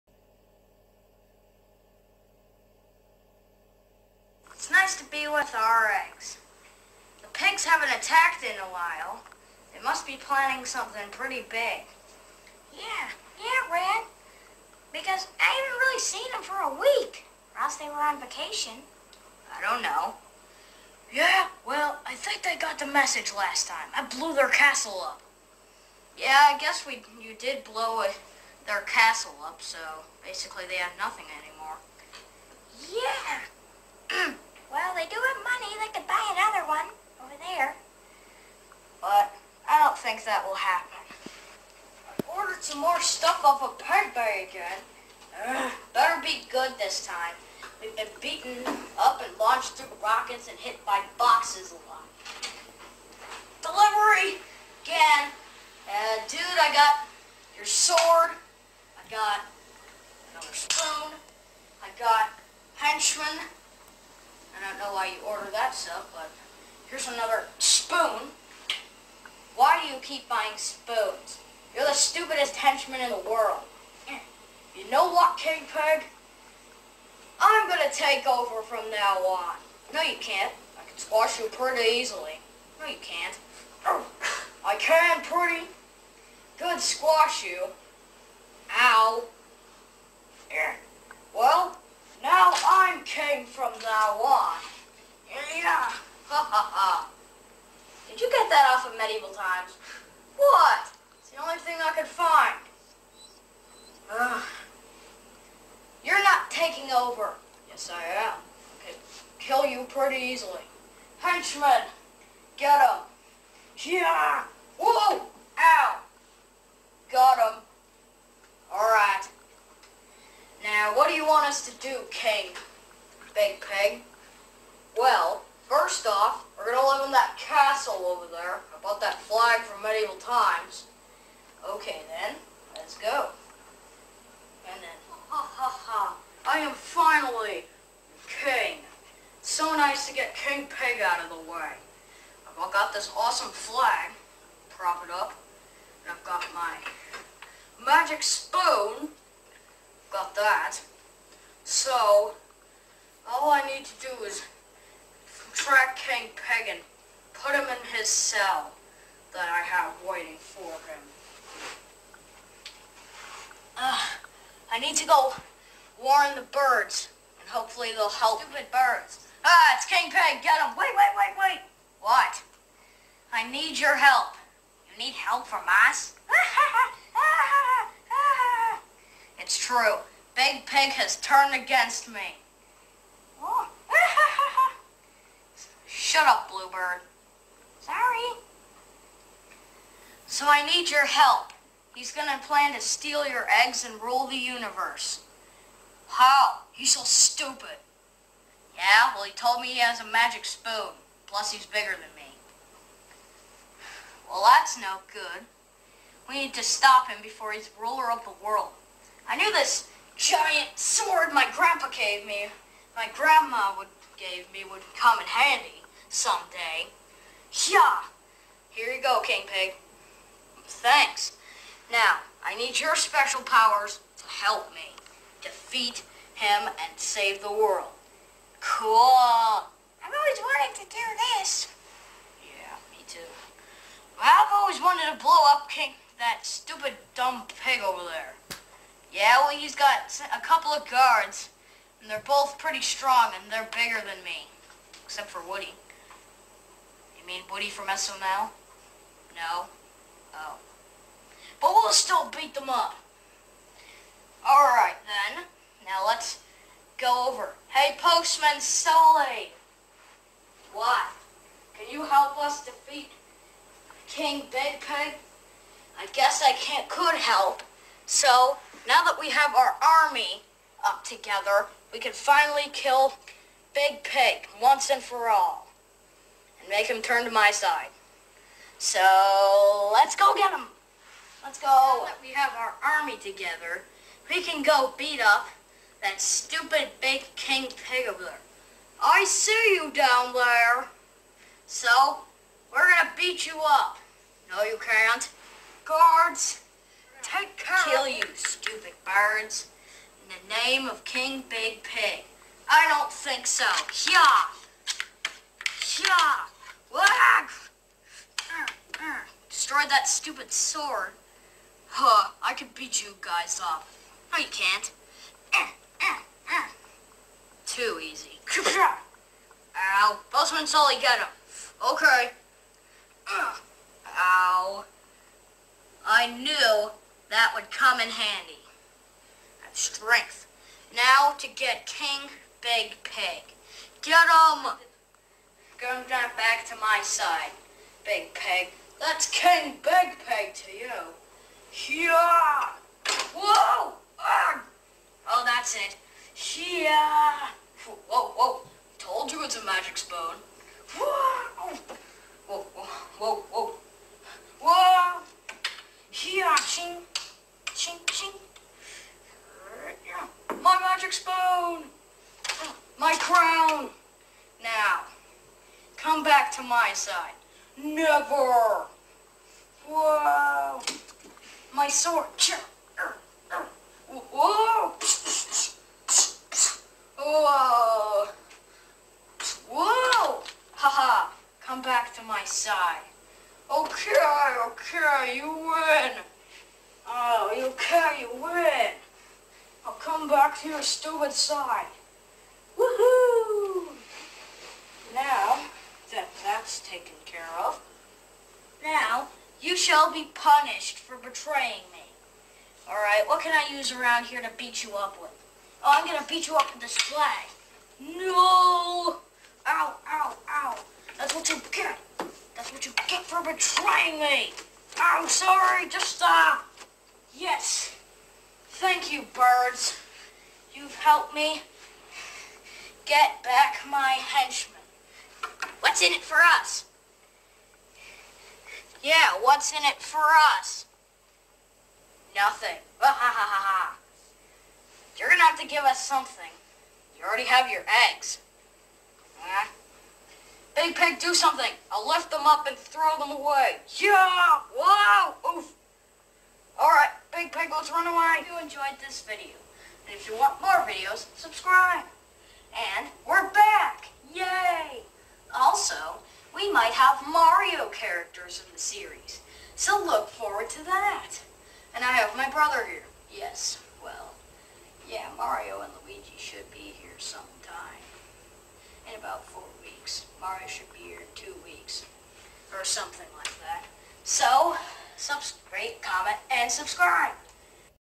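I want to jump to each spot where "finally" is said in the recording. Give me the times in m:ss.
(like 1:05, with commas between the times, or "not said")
2:16, 4:32.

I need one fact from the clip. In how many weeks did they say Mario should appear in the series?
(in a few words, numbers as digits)
2 weeks.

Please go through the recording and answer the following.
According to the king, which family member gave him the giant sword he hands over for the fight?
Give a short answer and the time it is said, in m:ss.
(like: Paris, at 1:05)
Grandma, at 3:33.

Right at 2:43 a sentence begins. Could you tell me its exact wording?
Uh, I need to go warn the birds, and hopefully they'll help.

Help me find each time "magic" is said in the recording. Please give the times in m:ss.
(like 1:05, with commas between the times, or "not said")
2:27, 3:20, 5:49.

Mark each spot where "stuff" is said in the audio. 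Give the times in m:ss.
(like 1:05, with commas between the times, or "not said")
0:43, 1:05.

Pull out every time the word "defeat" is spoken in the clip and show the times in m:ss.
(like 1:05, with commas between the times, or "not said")
3:45, 4:22.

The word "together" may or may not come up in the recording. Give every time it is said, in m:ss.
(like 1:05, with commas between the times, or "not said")
4:31, 4:43.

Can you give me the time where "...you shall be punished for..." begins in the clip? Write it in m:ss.
6:39.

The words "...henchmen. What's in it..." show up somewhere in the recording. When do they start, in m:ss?
7:04.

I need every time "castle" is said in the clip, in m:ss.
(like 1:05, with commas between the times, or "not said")
0:24, 0:28, 2:07.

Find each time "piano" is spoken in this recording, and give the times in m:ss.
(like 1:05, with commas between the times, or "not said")
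not said.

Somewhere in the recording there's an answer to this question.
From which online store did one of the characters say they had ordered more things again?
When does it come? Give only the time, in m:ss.
0:43.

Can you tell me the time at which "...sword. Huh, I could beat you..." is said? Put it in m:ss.
5:10.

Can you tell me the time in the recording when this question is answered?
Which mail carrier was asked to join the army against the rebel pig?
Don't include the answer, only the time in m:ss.
4:18.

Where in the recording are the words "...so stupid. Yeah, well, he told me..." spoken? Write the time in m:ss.
3:16.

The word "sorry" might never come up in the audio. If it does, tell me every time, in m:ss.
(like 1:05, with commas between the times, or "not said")
3:07, 6:55.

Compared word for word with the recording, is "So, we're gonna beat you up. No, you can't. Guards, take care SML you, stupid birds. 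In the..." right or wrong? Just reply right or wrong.
wrong.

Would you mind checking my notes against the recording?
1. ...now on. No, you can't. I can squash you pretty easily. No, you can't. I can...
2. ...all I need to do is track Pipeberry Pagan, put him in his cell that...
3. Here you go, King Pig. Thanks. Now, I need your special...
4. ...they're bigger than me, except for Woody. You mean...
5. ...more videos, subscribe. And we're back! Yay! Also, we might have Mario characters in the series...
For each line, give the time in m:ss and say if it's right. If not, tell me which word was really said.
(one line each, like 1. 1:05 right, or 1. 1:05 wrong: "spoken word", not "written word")
1. 1:18 right
2. 2:33 wrong: "King", not "Pipeberry"
3. 3:38 right
4. 4:03 right
5. 7:30 right.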